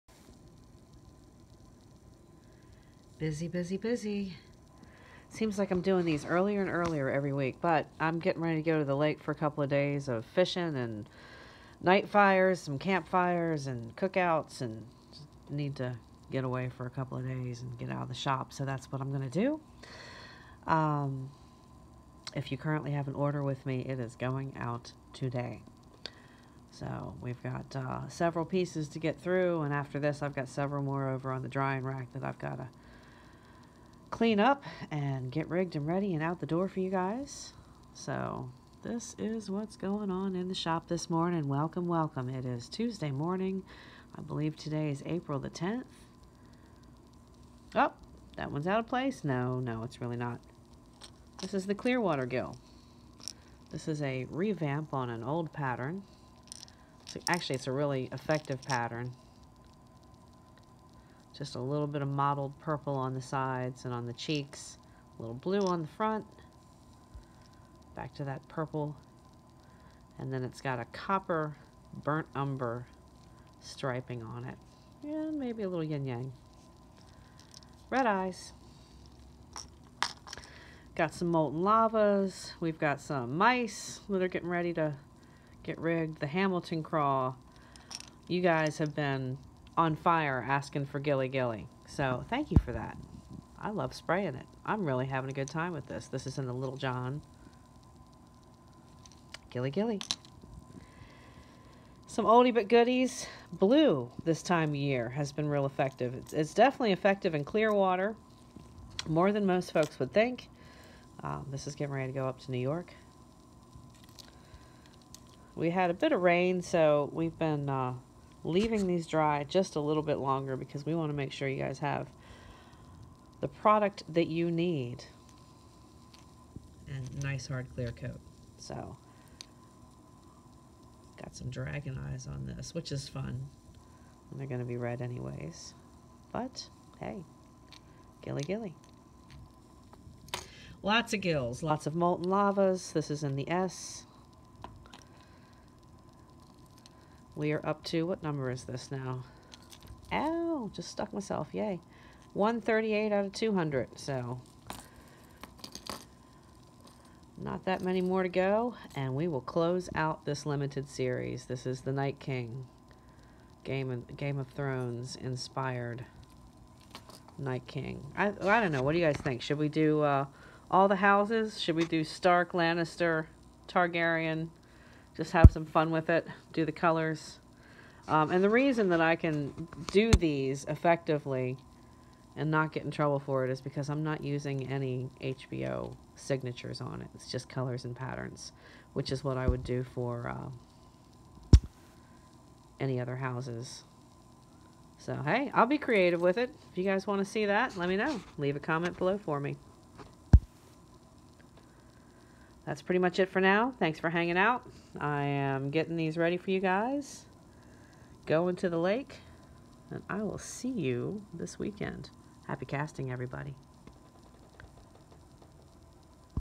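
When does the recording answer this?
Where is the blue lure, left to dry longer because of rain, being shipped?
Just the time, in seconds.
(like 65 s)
112 s.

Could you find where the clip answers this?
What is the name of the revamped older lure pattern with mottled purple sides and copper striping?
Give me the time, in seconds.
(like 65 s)
51 s.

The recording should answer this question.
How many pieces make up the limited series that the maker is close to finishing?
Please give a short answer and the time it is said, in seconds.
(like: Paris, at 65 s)
200, at 153 s.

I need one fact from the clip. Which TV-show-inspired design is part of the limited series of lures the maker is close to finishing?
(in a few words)
The Night King.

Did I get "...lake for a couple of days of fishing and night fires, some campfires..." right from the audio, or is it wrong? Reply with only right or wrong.
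right.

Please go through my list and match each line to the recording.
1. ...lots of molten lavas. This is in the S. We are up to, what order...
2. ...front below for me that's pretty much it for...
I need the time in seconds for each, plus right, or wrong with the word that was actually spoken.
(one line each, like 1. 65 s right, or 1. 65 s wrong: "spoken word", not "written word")
1. 141 s wrong: "number", not "order"
2. 198 s wrong: "comment", not "front".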